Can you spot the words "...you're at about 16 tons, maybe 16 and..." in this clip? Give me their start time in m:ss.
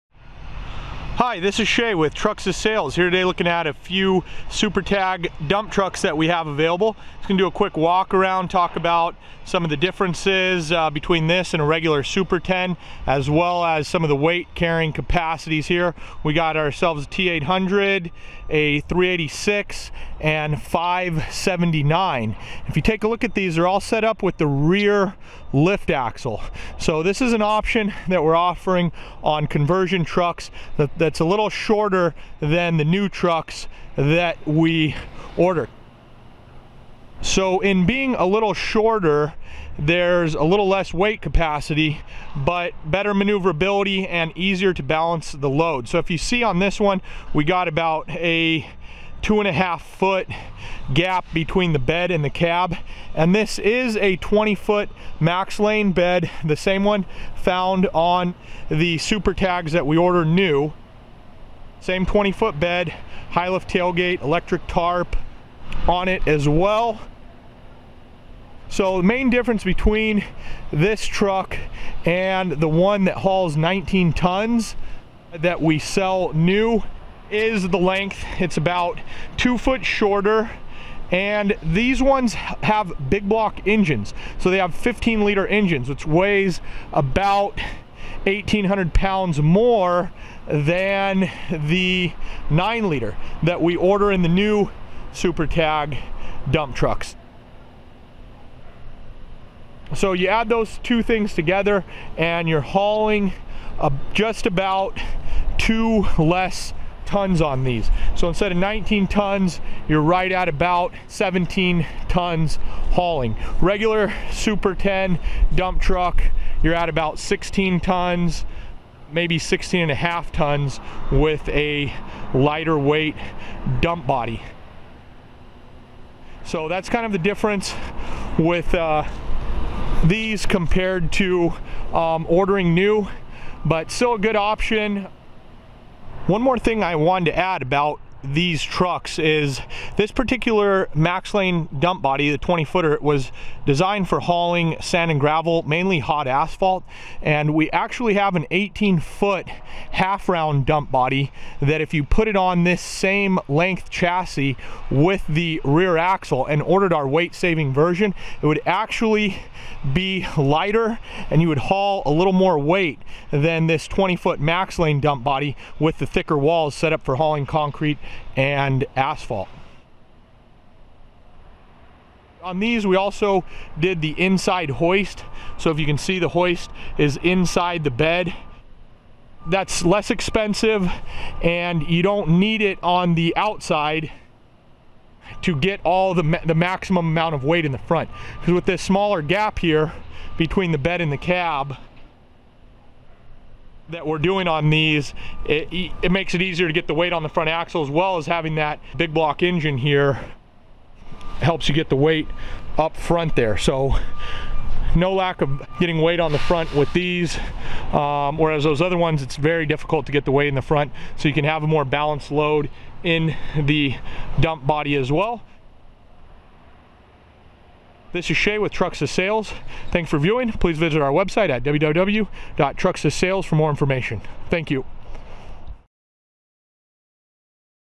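1:56.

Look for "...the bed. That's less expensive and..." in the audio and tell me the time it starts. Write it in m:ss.
2:57.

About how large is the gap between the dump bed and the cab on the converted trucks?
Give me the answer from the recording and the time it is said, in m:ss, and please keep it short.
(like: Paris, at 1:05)
2.5 feet, at 0:49.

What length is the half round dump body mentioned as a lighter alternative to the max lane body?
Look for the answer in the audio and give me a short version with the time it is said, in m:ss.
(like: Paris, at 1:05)
18 foot, at 2:28.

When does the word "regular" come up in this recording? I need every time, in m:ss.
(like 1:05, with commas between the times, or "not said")
0:11, 1:53.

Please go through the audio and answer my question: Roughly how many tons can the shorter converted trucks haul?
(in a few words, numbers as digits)
17 tons.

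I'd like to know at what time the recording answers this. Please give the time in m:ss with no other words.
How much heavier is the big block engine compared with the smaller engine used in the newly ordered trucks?
1:28.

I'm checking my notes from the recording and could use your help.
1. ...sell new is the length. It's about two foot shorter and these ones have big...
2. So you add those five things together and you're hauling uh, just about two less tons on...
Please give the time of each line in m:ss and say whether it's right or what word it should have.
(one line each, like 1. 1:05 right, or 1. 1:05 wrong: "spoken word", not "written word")
1. 1:15 right
2. 1:39 wrong: "two", not "five".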